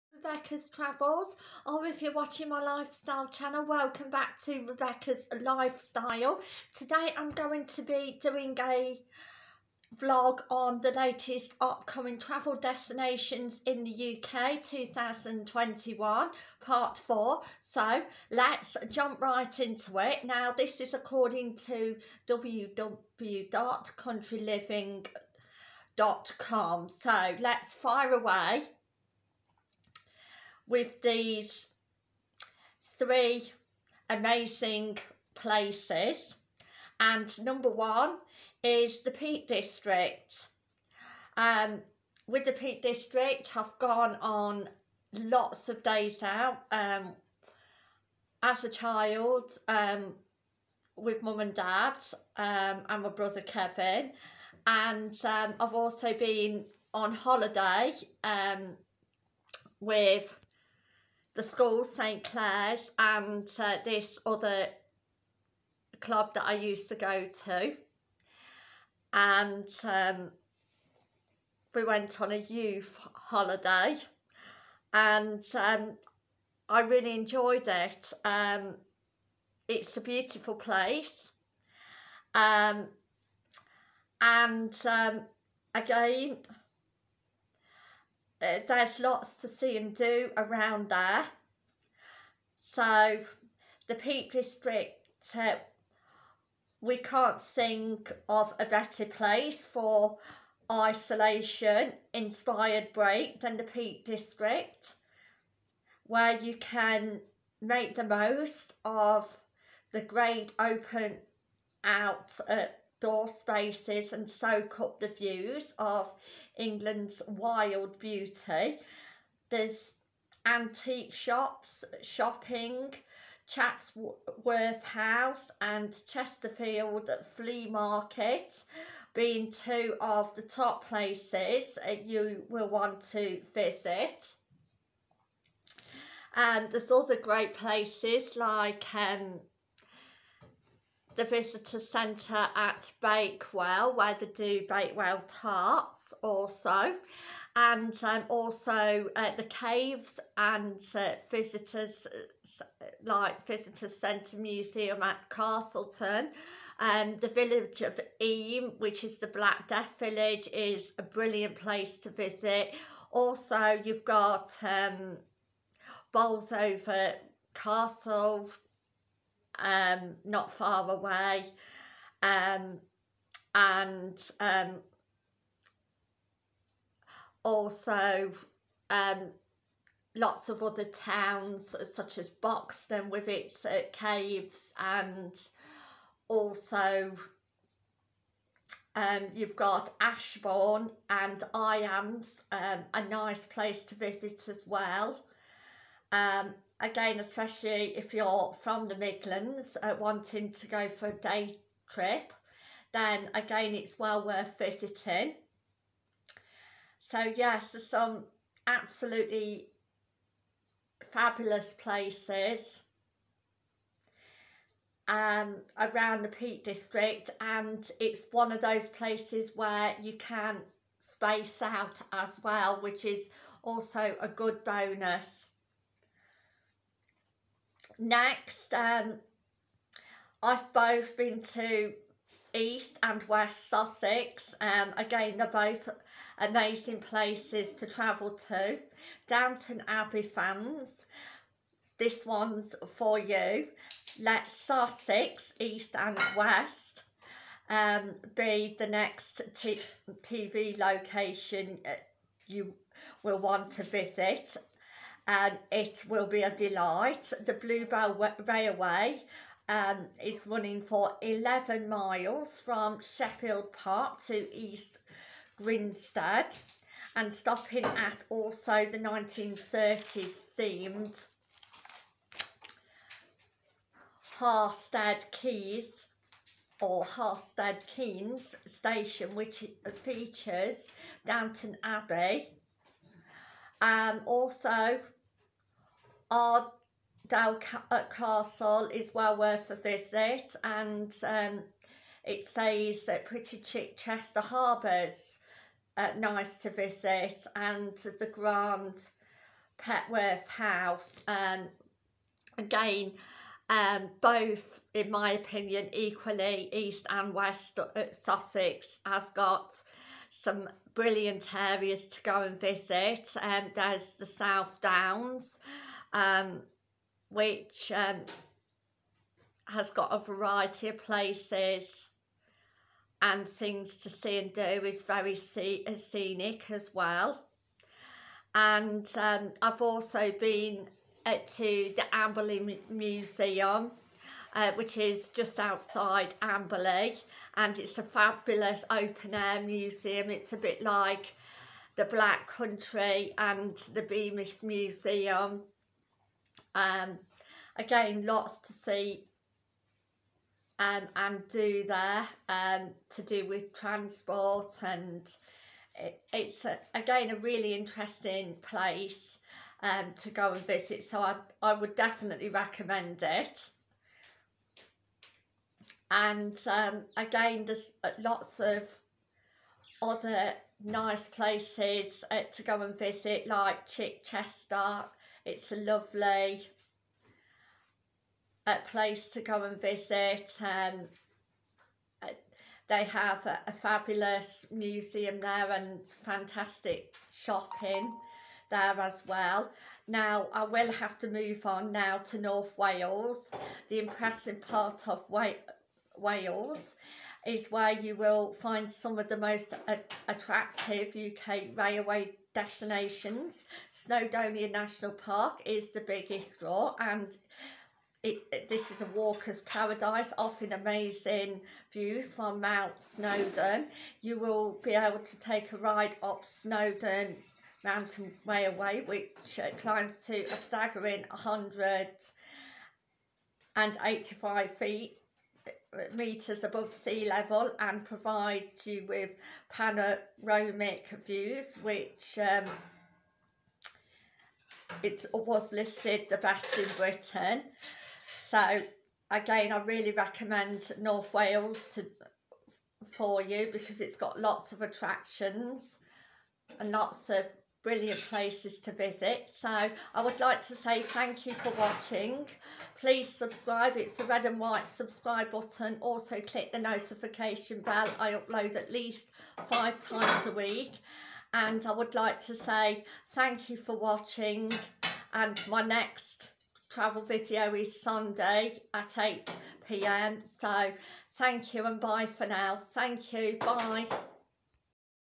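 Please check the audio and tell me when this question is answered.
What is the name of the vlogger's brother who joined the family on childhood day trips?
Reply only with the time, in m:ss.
0:53.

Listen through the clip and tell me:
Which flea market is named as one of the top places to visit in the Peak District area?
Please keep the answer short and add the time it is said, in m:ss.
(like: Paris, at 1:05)
Chesterfield Flea Market, at 2:06.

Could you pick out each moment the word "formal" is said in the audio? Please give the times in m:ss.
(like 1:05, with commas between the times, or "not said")
not said.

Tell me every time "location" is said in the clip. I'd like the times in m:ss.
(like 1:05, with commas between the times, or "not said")
4:10.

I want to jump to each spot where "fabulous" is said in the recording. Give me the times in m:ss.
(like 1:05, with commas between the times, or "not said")
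3:31, 5:38, 6:23.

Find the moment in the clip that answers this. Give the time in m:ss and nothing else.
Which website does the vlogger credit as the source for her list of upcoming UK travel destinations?
0:22.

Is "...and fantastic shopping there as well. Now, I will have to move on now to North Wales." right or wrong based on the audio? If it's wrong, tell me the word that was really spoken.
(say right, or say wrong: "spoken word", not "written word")
right.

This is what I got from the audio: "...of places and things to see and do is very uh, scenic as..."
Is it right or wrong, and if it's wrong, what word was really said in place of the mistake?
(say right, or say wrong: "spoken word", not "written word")
right.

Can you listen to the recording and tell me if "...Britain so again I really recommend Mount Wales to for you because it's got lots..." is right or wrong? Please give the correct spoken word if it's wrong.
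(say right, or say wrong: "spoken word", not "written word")
wrong: "North", not "Mount".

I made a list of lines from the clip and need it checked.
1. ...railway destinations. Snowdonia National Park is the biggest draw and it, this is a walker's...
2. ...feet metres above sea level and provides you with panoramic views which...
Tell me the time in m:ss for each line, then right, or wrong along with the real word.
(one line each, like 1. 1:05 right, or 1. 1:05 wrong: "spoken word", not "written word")
1. 6:41 right
2. 7:04 right.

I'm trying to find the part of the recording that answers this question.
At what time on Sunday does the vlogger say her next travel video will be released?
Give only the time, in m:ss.
7:49.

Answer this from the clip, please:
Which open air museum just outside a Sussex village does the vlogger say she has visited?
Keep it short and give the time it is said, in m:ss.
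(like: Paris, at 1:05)
Amberley Museum, at 5:32.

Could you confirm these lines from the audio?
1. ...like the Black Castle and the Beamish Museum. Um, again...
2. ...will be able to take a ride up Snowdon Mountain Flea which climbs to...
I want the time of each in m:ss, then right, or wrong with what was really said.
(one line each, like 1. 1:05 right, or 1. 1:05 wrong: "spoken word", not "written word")
1. 5:40 wrong: "Country", not "Castle"
2. 6:54 wrong: "Railway", not "Flea".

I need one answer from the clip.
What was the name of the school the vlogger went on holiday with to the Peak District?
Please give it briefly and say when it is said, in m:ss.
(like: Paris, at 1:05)
St Clair's, at 1:01.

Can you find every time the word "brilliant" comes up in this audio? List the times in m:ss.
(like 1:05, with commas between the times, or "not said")
2:41, 5:10, 7:27.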